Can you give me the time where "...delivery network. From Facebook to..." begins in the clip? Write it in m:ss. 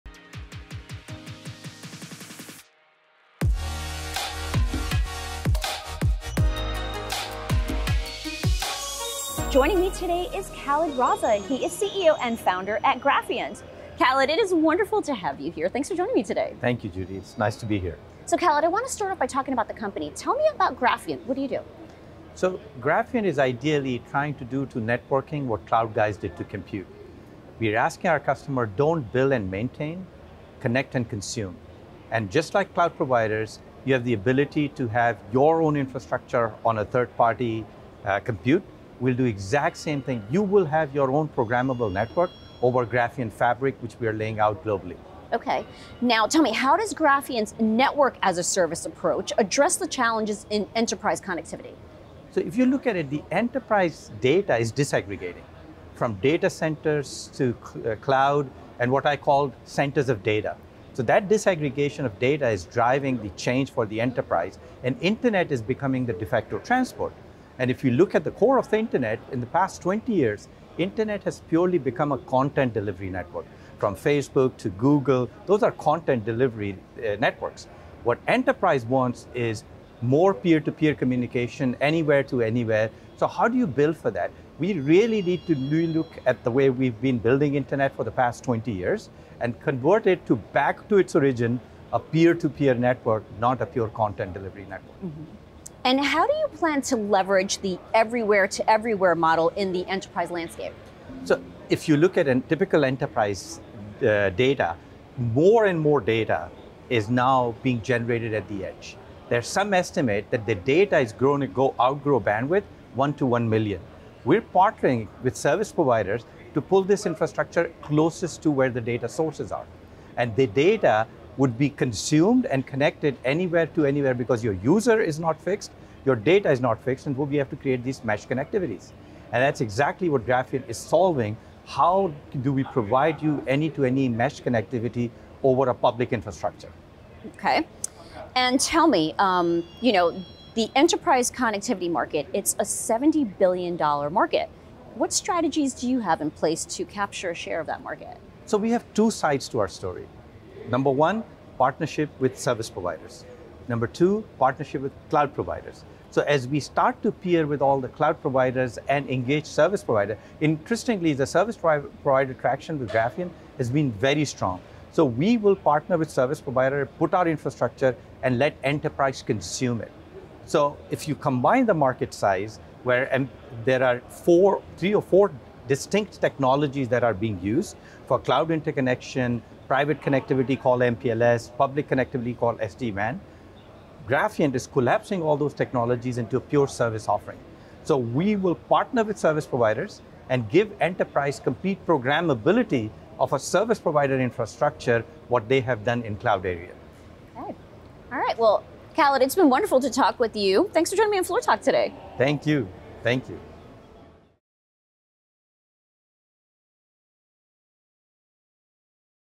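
1:12.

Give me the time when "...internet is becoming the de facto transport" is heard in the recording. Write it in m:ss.
1:05.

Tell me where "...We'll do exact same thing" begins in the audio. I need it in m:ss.
0:39.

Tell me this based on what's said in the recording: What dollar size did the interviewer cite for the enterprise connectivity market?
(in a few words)
$70 billion.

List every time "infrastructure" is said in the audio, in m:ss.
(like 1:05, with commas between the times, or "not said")
0:35, 1:57, 2:16, 2:47, 3:14.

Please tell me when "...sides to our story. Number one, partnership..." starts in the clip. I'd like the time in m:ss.
2:29.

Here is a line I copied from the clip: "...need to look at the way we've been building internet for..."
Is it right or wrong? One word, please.
right.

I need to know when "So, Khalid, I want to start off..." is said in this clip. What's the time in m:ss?
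0:18.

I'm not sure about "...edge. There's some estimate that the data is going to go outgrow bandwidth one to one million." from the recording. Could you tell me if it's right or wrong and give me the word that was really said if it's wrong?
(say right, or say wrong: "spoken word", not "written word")
right.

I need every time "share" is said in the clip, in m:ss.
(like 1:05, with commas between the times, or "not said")
2:27.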